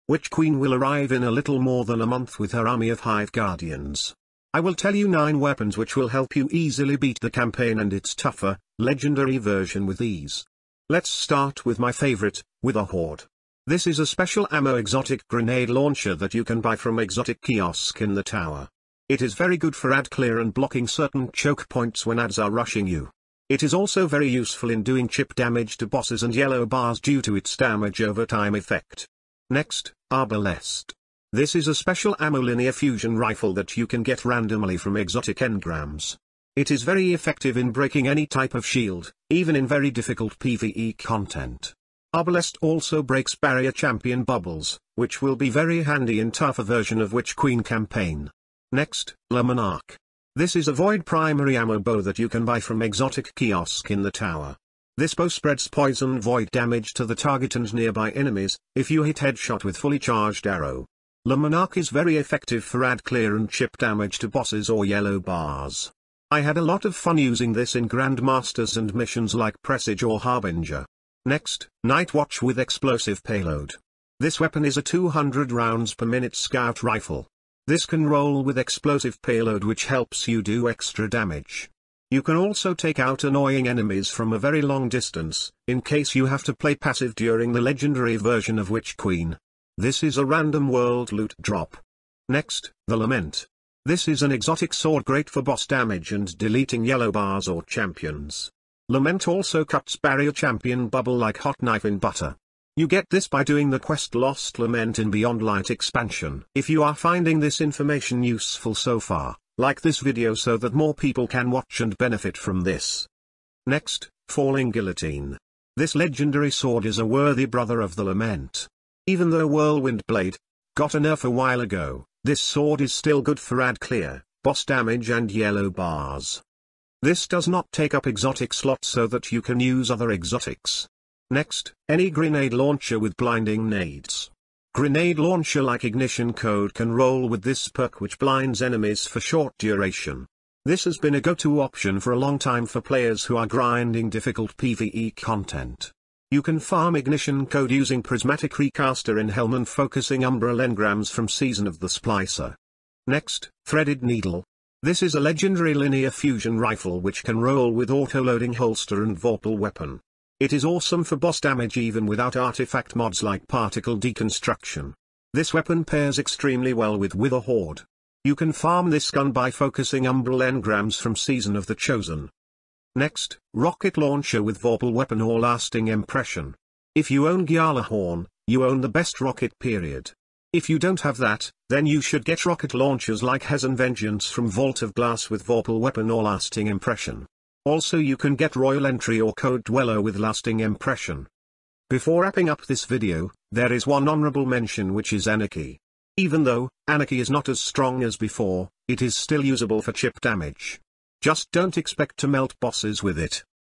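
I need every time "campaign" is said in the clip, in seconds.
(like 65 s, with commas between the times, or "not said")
7 s, 47 s.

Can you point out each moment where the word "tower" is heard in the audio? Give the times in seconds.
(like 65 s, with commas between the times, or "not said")
18 s, 54 s.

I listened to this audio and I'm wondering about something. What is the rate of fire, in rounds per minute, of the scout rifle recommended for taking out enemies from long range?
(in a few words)
200.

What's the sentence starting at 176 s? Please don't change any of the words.
If you own Gjallarhorn, you own the best rocket period.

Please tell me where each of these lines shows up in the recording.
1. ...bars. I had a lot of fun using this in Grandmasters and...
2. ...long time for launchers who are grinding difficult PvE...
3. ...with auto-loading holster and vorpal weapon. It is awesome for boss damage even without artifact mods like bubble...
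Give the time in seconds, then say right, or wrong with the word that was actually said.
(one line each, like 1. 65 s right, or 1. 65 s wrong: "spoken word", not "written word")
1. 65 s right
2. 142 s wrong: "players", not "launchers"
3. 157 s wrong: "particle", not "bubble".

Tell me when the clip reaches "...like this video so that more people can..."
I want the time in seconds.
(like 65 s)
109 s.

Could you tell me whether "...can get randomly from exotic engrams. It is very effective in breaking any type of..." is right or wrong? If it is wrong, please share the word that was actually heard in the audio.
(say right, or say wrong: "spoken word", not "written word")
right.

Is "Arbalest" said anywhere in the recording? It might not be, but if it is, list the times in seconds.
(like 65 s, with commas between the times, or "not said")
30 s, 42 s.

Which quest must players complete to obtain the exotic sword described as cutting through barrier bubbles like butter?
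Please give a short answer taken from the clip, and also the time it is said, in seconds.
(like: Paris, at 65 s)
Lost Lament, at 104 s.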